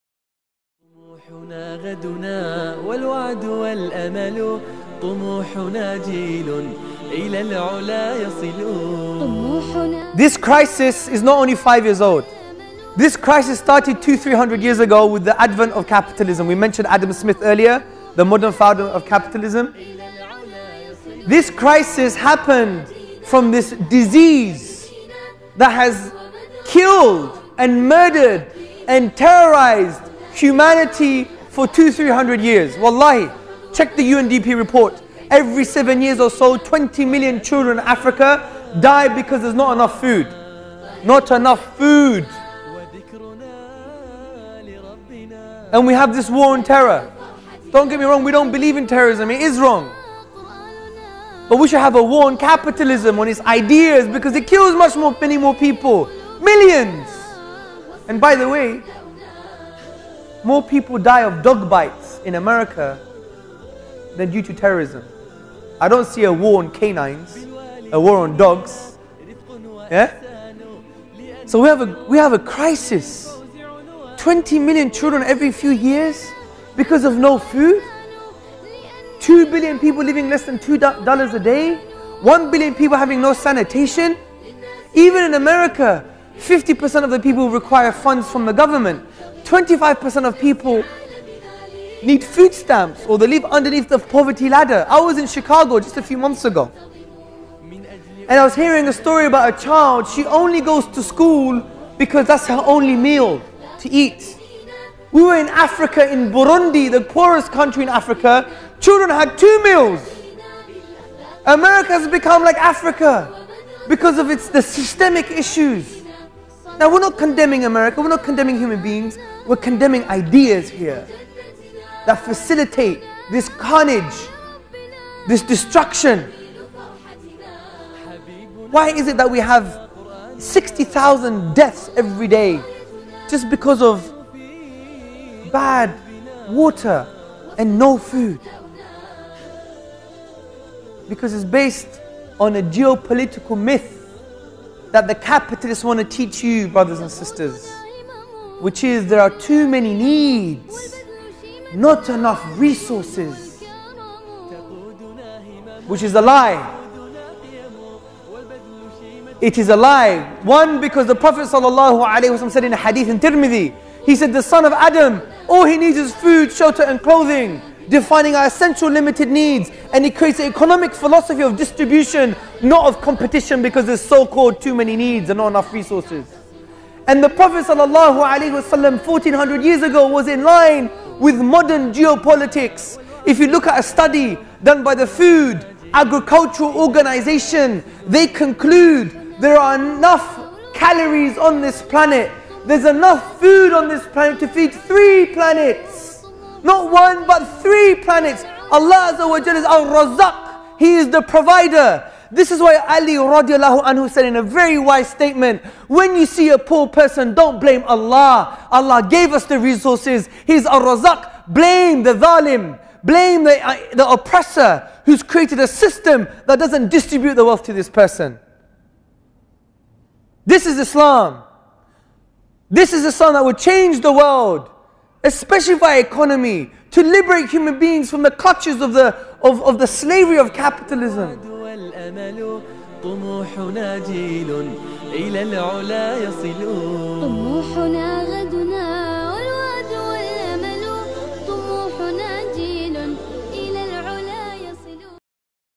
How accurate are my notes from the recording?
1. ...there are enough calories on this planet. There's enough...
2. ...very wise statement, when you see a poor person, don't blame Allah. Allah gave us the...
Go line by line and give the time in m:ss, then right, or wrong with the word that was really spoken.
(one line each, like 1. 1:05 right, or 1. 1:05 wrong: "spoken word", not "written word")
1. 3:09 right
2. 3:24 right.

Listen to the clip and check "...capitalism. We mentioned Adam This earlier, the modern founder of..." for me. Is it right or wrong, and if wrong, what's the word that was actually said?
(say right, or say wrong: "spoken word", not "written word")
wrong: "Smith", not "This".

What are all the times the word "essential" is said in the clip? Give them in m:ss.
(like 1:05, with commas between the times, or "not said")
2:48.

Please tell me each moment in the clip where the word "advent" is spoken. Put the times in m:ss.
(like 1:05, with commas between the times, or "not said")
0:15.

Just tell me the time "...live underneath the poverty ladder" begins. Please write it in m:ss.
1:33.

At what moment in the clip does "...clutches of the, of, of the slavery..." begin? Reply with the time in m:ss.
3:48.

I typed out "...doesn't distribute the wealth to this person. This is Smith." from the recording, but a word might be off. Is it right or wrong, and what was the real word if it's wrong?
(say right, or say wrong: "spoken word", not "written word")
wrong: "Islam", not "Smith".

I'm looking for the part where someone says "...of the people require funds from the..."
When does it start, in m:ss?
1:27.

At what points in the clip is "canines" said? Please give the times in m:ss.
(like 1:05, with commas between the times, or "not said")
1:06.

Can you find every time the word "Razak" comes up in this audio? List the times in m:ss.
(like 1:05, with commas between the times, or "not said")
3:19, 3:30.